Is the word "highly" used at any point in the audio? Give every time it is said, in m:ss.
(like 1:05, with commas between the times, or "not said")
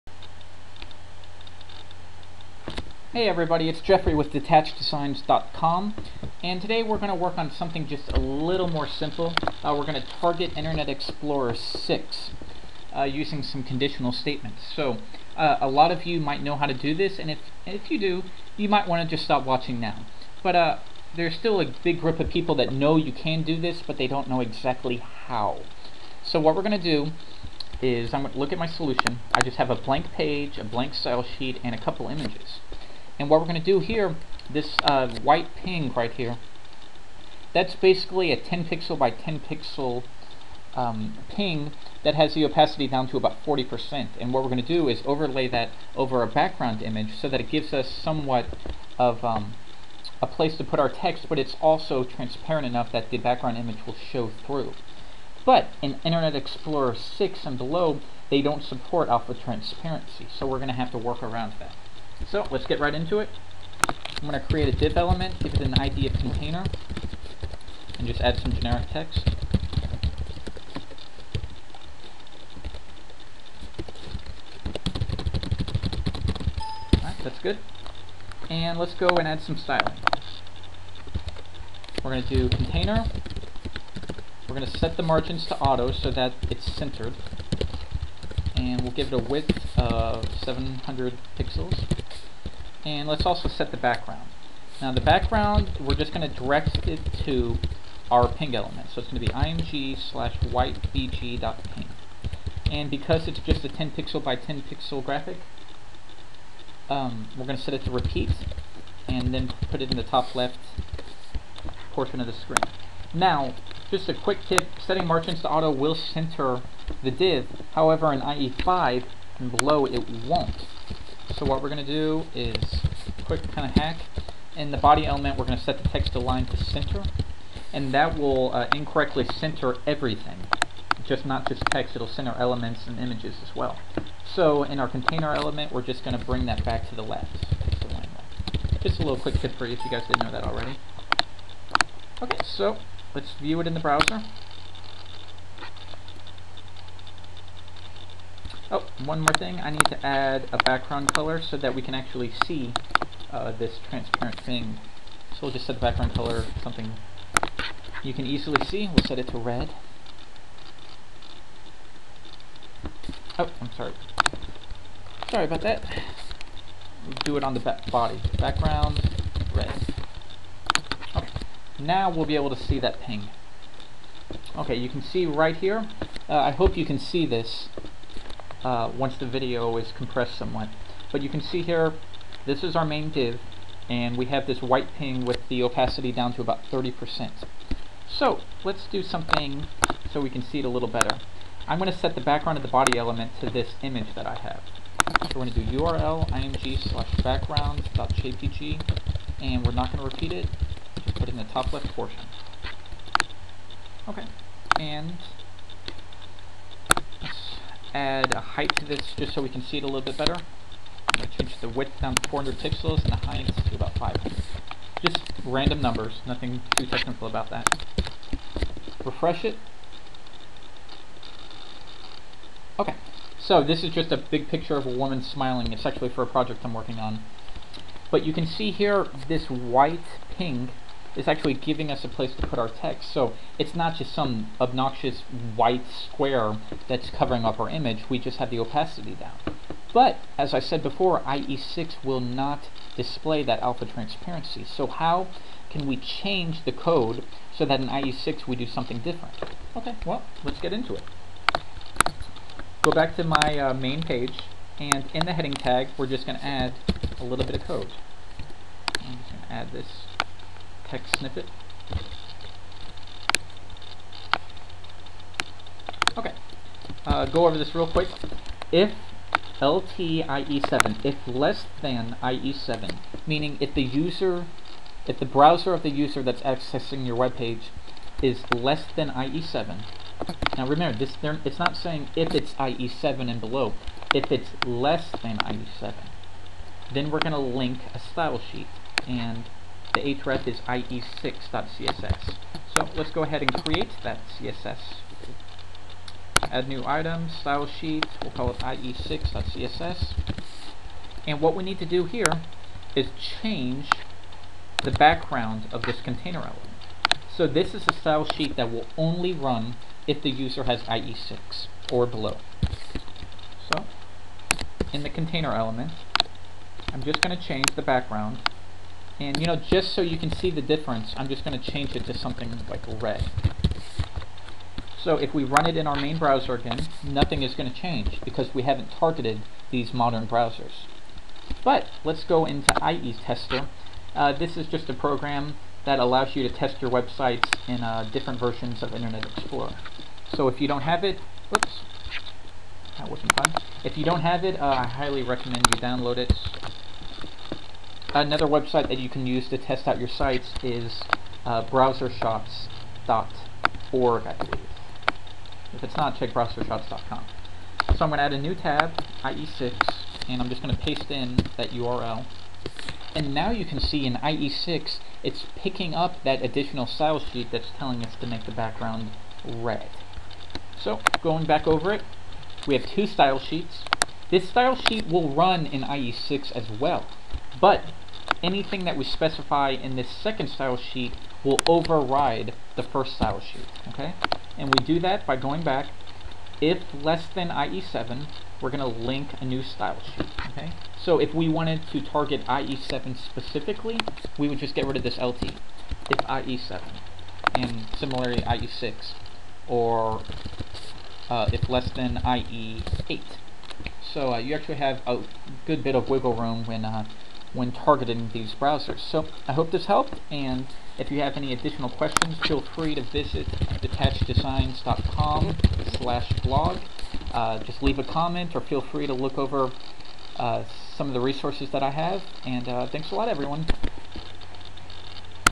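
5:44.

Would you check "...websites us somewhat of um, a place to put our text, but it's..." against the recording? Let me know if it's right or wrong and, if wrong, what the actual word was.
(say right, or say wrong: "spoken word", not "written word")
wrong: "gives", not "websites".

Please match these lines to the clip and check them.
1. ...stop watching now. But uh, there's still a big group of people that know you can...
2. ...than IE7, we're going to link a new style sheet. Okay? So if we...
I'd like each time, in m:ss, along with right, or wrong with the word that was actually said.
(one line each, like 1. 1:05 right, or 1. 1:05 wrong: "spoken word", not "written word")
1. 0:19 right
2. 6:27 right.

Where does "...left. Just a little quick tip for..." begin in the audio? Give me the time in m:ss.
2:17.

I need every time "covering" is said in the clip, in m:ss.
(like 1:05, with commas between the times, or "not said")
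3:57.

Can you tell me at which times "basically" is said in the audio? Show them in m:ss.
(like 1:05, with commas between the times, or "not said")
0:37.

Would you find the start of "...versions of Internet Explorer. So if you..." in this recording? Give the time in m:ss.
5:38.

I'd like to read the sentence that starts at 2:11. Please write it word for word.
It'll center elements and images as well.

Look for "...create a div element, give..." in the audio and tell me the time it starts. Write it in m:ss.
1:04.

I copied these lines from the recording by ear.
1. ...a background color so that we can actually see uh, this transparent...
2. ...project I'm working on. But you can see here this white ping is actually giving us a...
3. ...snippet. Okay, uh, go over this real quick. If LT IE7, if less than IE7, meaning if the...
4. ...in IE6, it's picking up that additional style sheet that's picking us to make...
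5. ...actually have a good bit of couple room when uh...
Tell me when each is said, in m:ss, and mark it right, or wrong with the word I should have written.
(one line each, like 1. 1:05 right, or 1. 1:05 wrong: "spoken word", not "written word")
1. 2:30 right
2. 3:46 right
3. 4:21 right
4. 6:04 wrong: "telling", not "picking"
5. 6:44 wrong: "wiggle", not "couple".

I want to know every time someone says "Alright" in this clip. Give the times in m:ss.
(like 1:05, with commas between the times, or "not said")
1:16.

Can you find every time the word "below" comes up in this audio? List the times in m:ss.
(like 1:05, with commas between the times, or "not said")
0:57, 1:59, 4:43, 5:12.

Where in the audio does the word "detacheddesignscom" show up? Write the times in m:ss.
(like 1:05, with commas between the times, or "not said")
0:04, 6:53.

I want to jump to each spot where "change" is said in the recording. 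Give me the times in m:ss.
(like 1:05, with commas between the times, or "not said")
3:31, 4:05, 5:03, 5:17, 5:21, 5:27.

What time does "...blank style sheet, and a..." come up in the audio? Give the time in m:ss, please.
0:30.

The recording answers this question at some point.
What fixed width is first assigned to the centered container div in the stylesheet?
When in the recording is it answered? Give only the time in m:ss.
1:30.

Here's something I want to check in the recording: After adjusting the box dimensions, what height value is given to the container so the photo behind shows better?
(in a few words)
500.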